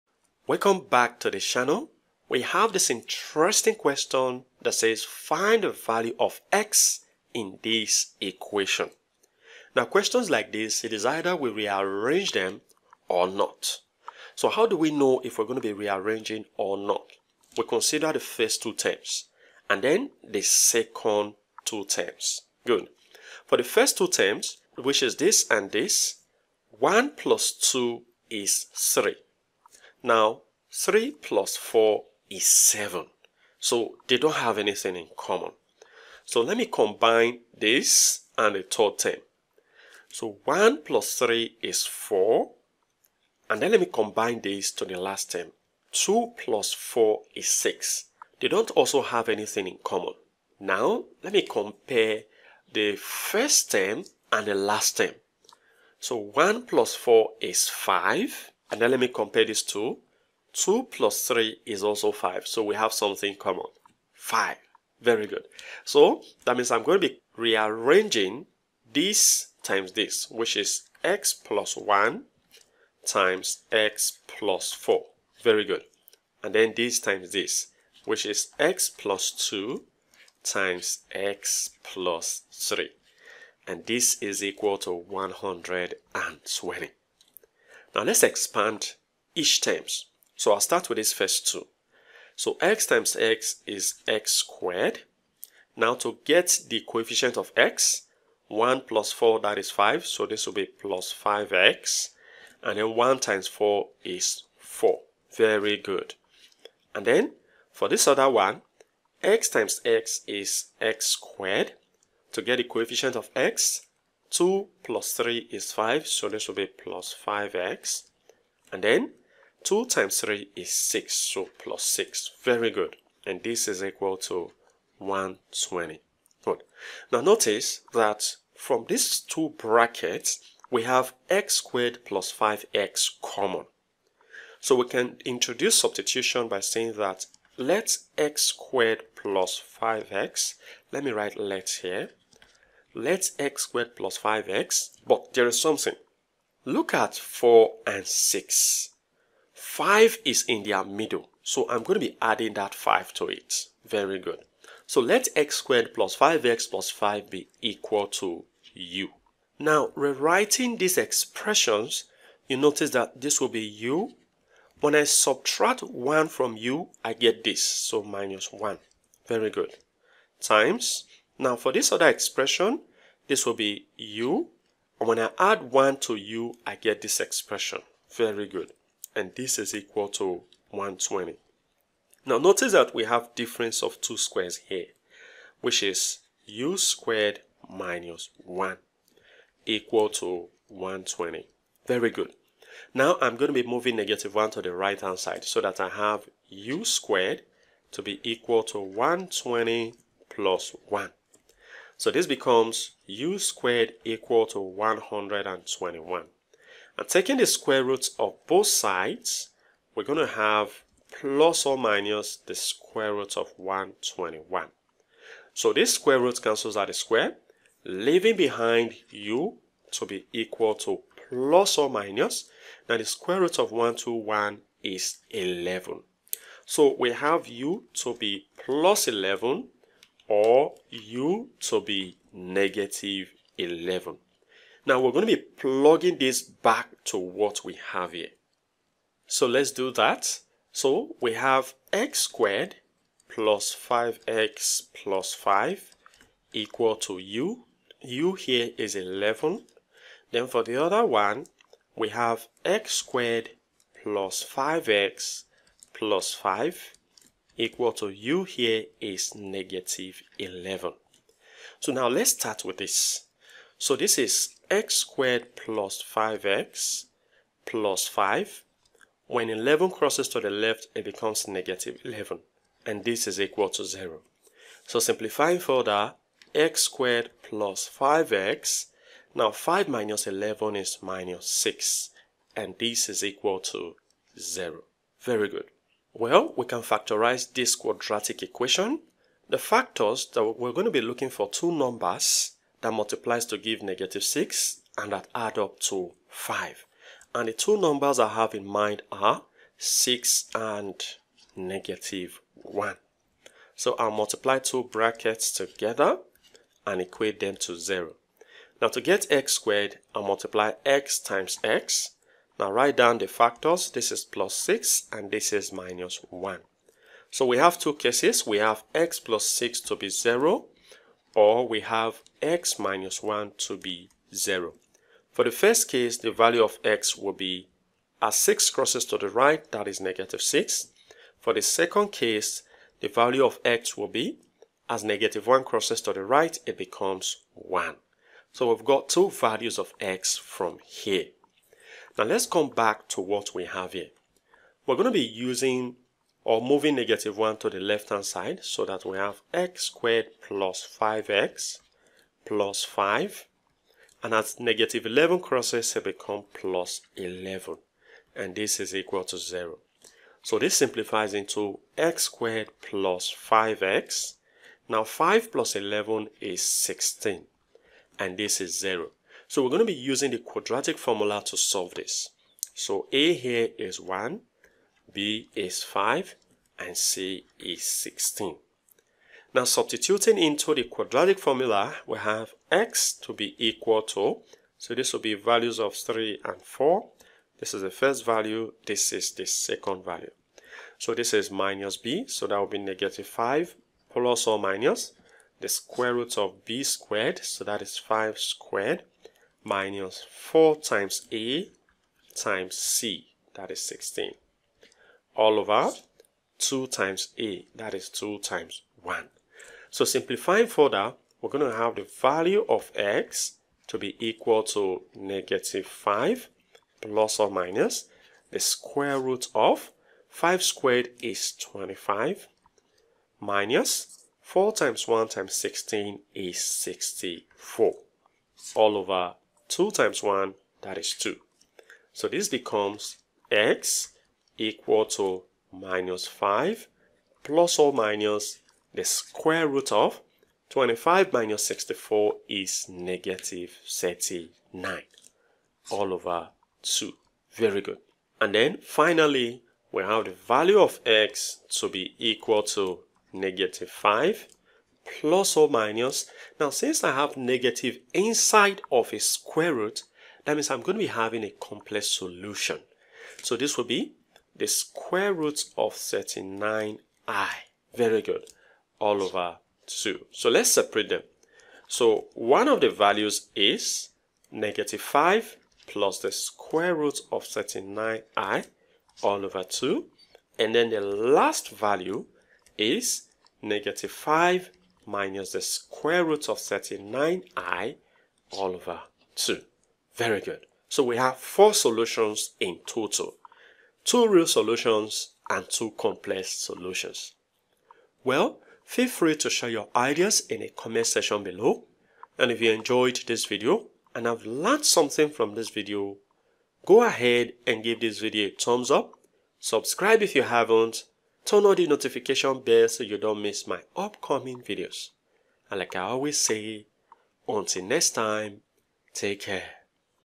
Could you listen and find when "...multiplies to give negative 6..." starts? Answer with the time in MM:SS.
04:52.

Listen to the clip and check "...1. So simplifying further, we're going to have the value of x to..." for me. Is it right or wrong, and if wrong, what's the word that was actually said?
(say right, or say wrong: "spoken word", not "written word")
right.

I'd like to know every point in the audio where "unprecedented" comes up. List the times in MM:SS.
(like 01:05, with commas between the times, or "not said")
not said.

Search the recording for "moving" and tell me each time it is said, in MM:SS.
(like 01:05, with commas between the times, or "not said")
03:13, 05:46.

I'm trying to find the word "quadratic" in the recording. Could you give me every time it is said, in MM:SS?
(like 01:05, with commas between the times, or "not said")
04:47, 06:10, 06:20.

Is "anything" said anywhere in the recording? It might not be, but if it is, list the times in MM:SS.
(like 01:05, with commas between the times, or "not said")
00:34, 00:49.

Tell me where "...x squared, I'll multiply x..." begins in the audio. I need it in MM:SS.
05:09.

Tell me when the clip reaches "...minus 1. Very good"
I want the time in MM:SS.
02:48.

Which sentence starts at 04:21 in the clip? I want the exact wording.
So now let's start with this.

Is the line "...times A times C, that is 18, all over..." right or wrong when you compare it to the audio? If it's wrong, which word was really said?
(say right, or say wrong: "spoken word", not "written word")
wrong: "16", not "18".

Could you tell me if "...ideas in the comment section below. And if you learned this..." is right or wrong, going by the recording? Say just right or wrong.
wrong.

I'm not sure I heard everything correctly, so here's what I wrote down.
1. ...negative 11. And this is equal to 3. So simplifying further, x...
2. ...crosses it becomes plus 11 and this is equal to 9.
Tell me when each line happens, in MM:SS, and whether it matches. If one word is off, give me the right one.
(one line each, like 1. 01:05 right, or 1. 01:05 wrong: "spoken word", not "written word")
1. 04:31 wrong: "0", not "3"
2. 05:55 wrong: "0", not "9".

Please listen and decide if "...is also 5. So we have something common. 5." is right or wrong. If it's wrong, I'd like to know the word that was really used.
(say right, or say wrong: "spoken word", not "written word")
right.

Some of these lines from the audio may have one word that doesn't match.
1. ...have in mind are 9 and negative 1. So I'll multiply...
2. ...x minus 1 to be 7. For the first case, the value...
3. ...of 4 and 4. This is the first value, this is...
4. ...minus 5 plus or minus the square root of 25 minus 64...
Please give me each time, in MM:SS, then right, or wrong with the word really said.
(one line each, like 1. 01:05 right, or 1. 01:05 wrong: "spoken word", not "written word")
1. 04:58 wrong: "6", not "9"
2. 05:22 wrong: "0", not "7"
3. 06:25 wrong: "3", not "4"
4. 07:15 right.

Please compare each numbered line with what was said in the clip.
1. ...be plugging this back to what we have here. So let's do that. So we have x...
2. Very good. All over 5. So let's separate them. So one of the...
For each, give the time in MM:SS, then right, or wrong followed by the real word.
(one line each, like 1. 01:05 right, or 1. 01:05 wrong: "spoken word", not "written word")
1. 03:55 right
2. 07:47 wrong: "2", not "5".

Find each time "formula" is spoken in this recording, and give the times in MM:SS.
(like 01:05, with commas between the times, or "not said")
06:10, 06:21.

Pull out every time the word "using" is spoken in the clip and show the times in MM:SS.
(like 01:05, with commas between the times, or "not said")
05:45, 06:09.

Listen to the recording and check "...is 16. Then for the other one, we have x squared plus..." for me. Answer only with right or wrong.
wrong.